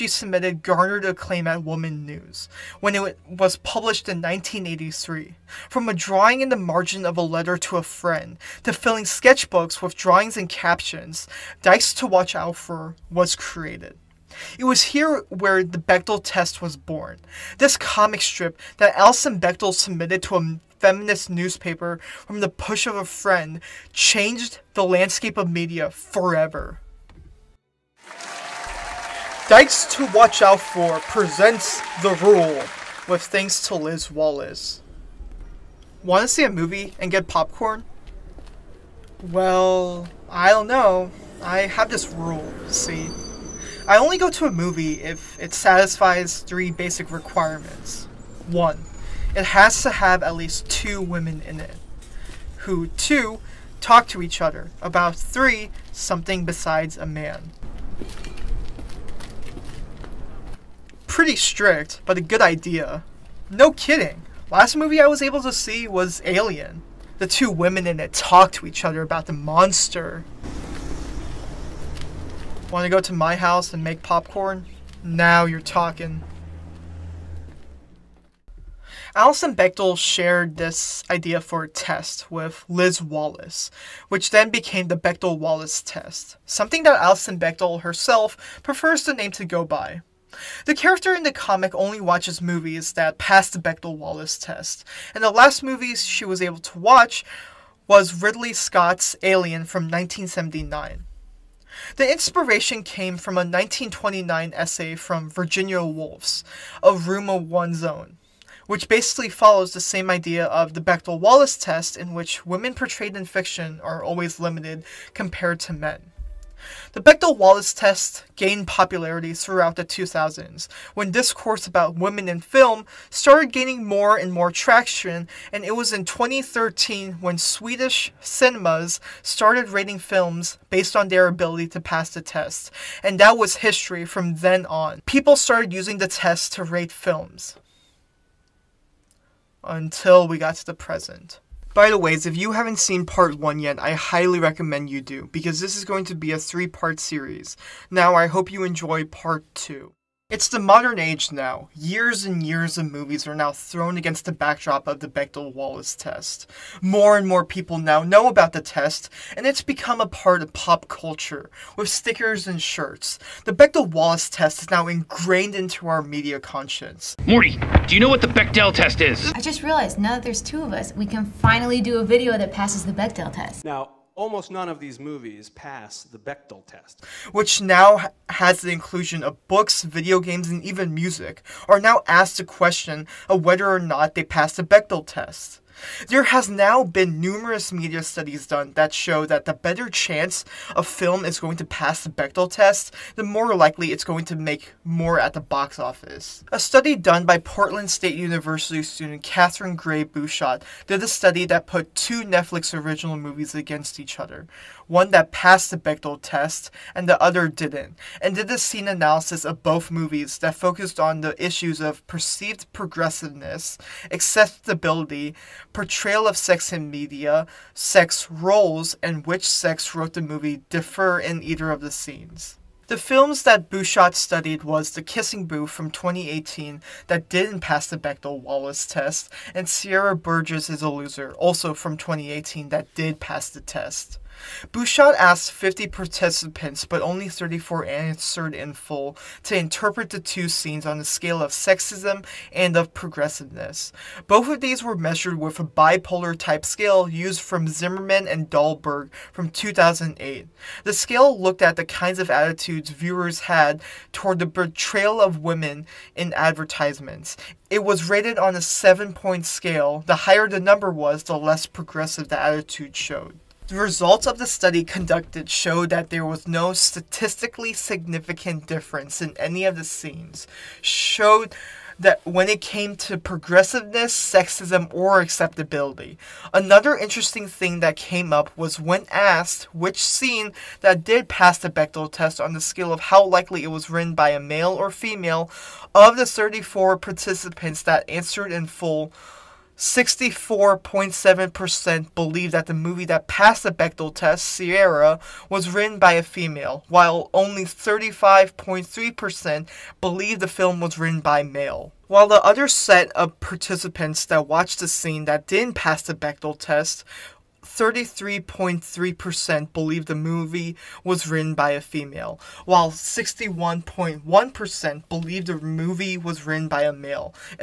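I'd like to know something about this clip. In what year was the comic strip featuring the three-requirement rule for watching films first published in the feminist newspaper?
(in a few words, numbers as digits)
1983.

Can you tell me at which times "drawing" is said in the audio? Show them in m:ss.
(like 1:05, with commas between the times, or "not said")
0:05, 0:09.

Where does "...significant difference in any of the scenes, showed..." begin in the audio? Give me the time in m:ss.
4:27.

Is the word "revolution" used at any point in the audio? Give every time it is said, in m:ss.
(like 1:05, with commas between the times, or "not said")
not said.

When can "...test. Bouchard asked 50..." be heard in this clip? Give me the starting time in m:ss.
3:53.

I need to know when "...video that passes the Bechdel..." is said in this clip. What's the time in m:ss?
2:52.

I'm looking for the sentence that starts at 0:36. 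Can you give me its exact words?
Want to see a movie and get popcorn?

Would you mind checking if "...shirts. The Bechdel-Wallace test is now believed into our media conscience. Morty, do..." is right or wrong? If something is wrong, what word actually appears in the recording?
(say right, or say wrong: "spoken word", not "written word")
wrong: "ingrained", not "believed".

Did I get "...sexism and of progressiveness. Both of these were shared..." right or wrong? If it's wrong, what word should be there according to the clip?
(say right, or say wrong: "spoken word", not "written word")
wrong: "measured", not "shared".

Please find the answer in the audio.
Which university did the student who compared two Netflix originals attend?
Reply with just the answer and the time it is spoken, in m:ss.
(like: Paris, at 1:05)
Portland State University, at 3:17.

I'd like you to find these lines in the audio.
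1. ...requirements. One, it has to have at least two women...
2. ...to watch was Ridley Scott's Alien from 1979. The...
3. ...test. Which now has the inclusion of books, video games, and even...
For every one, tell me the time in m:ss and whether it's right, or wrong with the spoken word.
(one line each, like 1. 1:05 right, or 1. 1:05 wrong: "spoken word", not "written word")
1. 0:47 right
2. 1:36 right
3. 2:56 right.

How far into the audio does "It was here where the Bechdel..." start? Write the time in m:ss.
0:14.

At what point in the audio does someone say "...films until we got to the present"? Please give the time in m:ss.
2:16.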